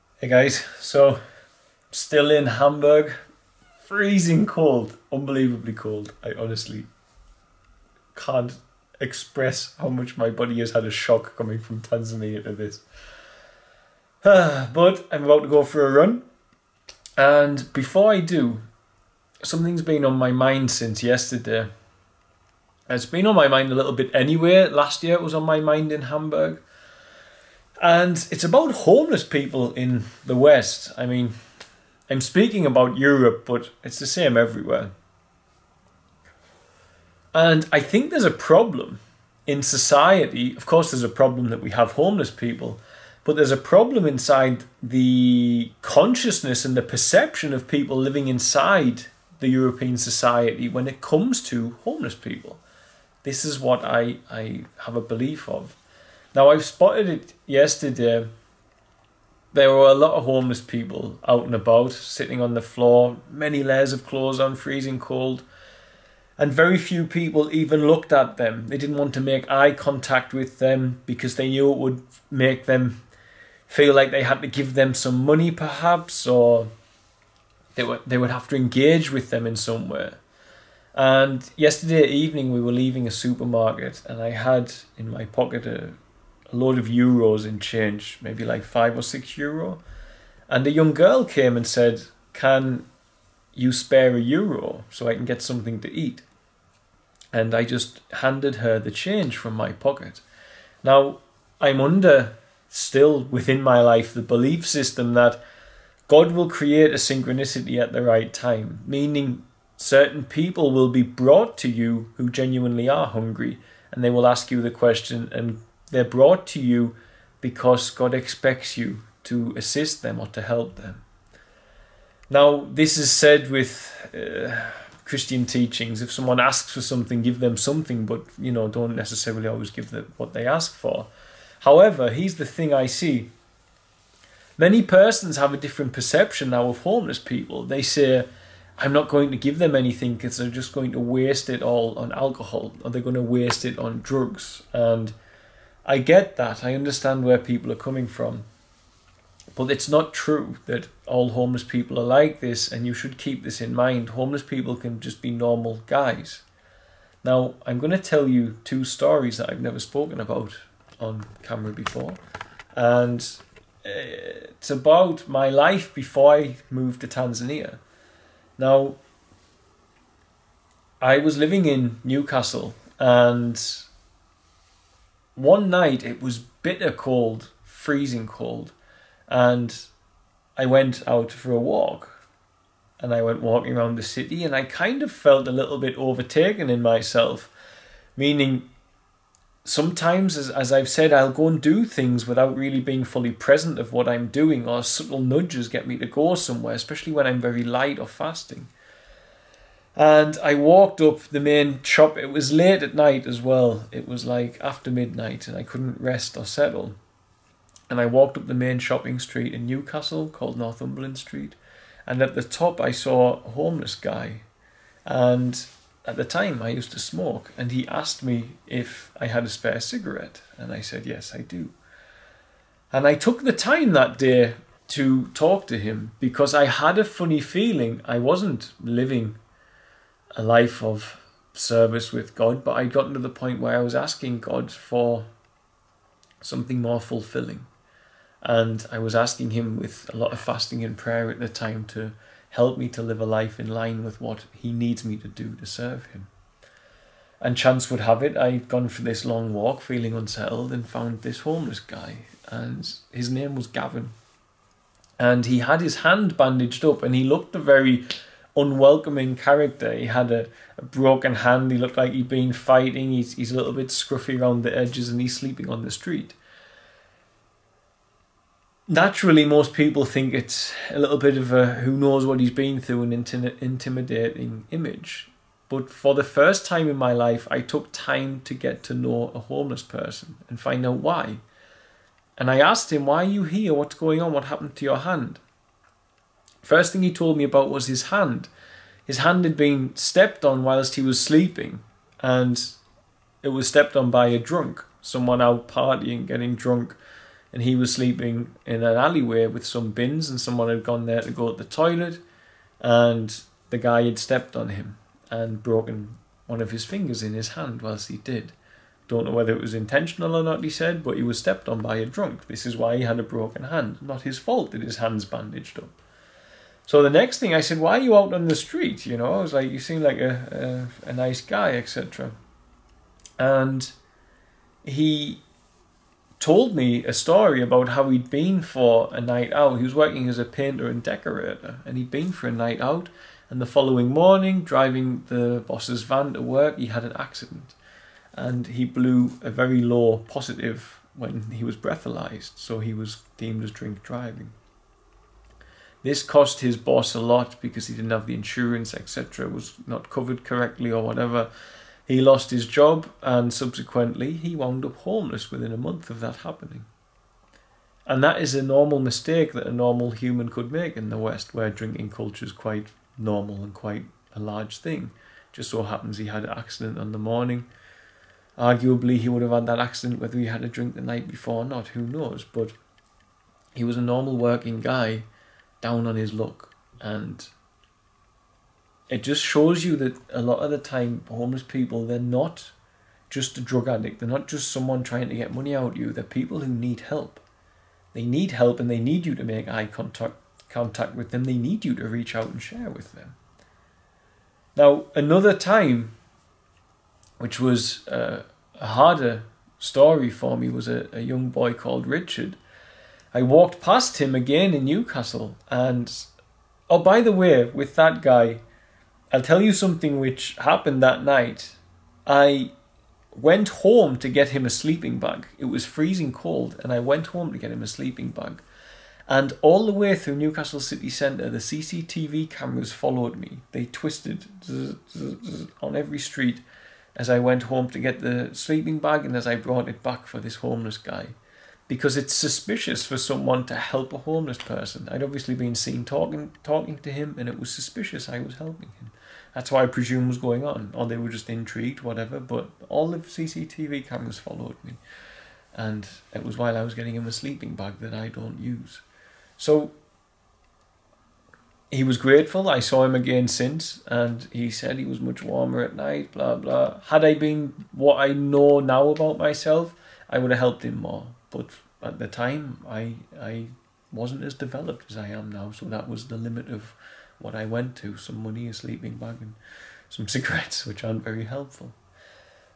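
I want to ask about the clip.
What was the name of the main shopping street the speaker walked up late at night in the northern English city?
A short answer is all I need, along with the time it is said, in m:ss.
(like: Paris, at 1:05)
Northumberland Street, at 3:30.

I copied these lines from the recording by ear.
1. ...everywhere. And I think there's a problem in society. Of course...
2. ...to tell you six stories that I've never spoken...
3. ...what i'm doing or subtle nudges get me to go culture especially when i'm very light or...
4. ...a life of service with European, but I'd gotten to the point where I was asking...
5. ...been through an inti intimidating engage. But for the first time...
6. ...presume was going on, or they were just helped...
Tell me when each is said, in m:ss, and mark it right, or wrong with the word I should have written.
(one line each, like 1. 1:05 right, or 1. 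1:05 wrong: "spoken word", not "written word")
1. 0:34 right
2. 2:37 wrong: "two", not "six"
3. 3:13 wrong: "somewhere", not "culture"
4. 3:50 wrong: "God", not "European"
5. 4:32 wrong: "image", not "engage"
6. 7:19 wrong: "intrigued", not "helped".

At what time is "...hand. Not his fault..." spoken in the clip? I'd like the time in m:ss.
5:13.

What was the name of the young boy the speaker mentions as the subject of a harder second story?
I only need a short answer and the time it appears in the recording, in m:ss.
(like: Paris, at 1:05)
Richard, at 6:42.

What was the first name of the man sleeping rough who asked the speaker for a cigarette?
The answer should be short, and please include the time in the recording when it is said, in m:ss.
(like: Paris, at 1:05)
Gavin, at 4:13.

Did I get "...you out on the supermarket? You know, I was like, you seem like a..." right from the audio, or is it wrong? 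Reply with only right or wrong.
wrong.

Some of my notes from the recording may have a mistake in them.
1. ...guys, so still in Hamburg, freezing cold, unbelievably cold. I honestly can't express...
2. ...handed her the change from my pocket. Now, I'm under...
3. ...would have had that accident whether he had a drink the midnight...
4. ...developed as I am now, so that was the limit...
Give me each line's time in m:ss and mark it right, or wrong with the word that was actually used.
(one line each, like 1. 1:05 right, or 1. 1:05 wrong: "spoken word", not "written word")
1. 0:00 right
2. 1:38 right
3. 6:09 wrong: "night", not "midnight"
4. 7:44 right.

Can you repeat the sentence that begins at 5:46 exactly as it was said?
This cost his boss a lot because he didn't have the insurance, etc., was not covered correctly or whatever.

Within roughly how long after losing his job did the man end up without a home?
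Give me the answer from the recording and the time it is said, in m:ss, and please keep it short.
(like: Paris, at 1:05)
a month, at 5:55.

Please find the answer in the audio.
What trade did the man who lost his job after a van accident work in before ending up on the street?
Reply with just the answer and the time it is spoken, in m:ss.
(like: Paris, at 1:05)
painter and decorator, at 5:30.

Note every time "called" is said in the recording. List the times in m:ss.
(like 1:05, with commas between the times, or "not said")
3:30, 6:41.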